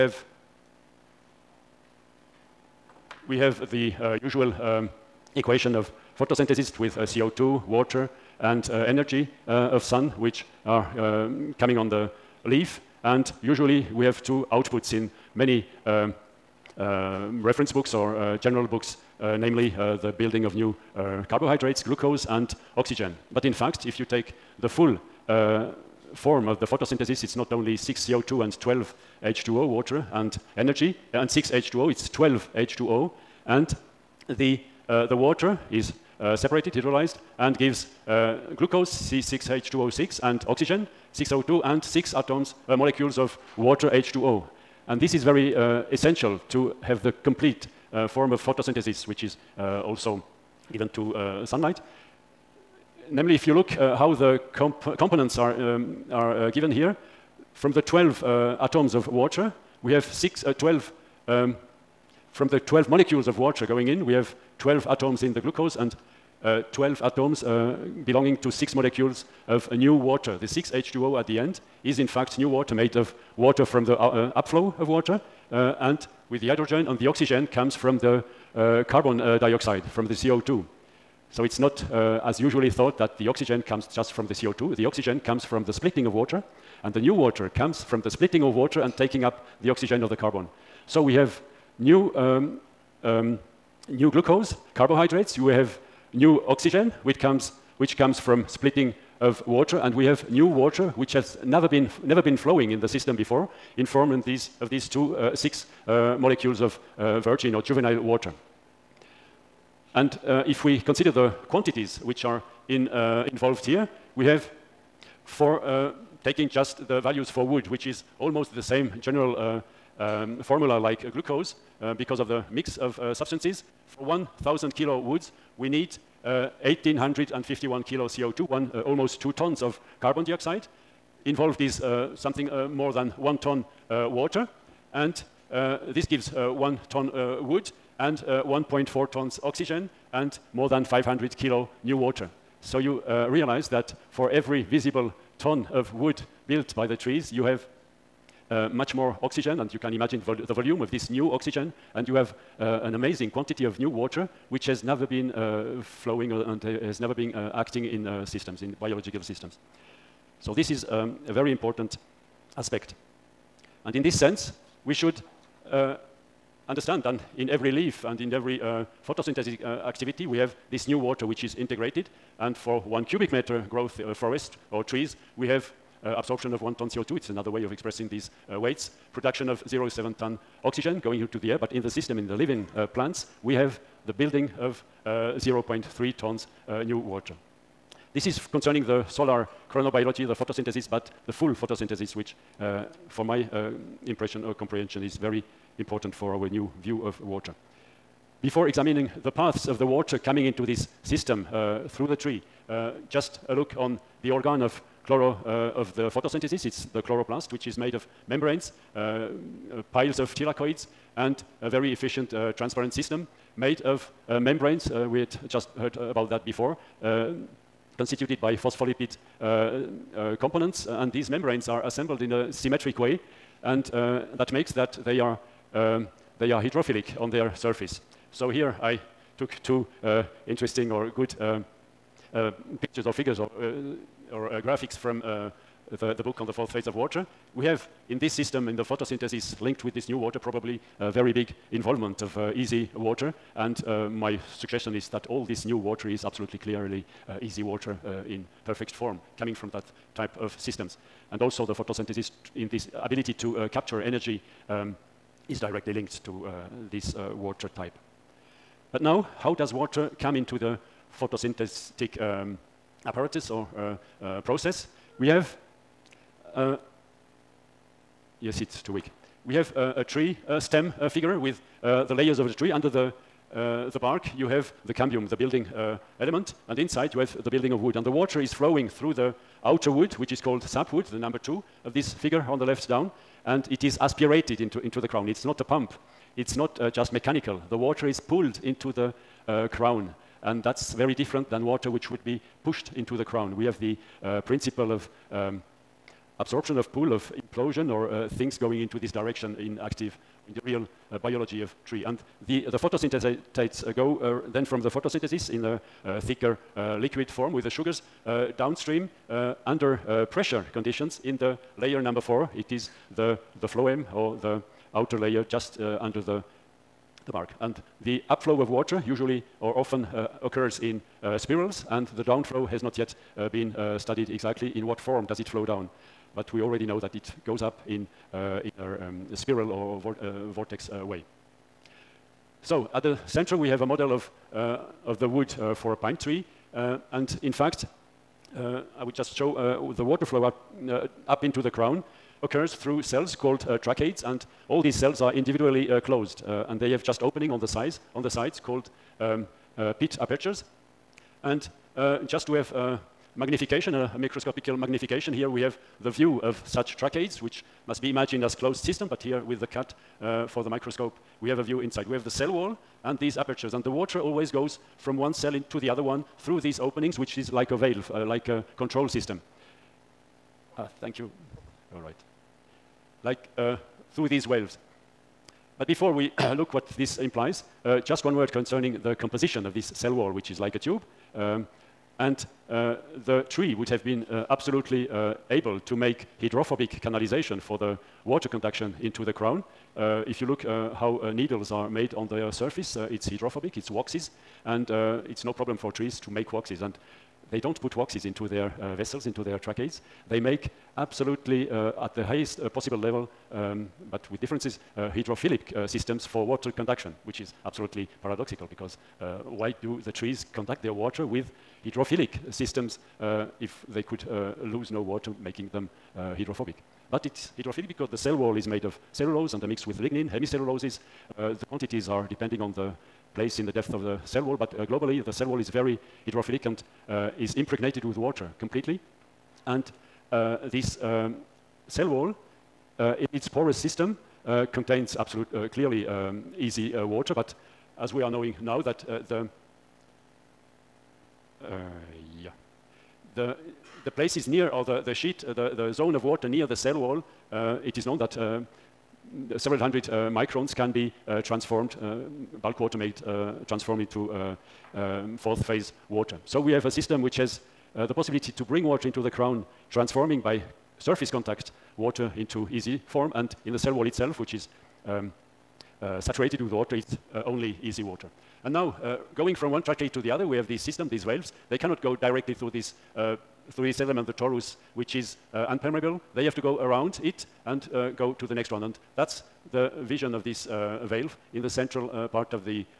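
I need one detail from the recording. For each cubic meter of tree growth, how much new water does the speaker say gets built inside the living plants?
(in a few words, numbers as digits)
0.3 tons.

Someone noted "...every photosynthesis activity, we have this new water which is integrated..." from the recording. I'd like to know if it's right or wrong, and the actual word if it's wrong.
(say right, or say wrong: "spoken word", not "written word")
right.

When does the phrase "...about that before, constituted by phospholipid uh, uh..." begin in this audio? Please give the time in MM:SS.
03:35.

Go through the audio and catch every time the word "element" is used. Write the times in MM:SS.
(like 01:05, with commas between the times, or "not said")
04:36, 07:53.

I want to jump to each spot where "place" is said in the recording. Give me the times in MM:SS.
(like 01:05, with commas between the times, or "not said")
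07:03, 07:24.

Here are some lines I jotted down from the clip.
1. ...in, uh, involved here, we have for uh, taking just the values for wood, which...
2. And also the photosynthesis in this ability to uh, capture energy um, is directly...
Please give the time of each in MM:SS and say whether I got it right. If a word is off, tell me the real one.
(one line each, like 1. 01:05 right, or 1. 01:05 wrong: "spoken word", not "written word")
1. 01:52 right
2. 04:11 right.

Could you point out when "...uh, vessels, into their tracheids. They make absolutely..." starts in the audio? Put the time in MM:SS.
06:38.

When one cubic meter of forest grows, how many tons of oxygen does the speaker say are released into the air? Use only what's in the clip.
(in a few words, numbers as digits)
0.7 tons.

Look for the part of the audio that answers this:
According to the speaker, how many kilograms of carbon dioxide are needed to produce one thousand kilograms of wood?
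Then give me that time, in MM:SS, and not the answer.
02:06.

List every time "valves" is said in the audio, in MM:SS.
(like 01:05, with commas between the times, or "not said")
07:51, 08:01.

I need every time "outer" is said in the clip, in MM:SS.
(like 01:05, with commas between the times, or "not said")
04:39, 05:14.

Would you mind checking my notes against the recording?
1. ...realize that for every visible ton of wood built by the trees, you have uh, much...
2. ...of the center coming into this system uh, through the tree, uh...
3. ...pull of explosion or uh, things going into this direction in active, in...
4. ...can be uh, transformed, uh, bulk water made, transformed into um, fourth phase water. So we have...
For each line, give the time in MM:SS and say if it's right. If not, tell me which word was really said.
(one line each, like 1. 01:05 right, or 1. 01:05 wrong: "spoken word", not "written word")
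1. 02:23 right
2. 03:19 wrong: "water", not "center"
3. 04:56 right
4. 07:30 right.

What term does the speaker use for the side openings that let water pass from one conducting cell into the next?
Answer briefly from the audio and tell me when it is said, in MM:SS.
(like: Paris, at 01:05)
pit apertures, at 05:49.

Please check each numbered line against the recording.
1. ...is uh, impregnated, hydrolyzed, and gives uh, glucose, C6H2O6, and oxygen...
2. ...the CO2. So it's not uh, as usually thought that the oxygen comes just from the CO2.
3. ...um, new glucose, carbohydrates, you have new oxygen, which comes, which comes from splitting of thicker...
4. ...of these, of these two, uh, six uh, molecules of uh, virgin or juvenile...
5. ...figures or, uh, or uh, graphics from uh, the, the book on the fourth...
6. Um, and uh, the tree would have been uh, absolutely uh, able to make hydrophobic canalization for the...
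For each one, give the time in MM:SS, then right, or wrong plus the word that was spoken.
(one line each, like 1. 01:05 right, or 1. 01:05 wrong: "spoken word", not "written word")
1. 00:35 wrong: "separated", not "impregnated"
2. 01:20 right
3. 01:33 wrong: "water", not "thicker"
4. 01:44 right
5. 03:53 right
6. 06:21 right.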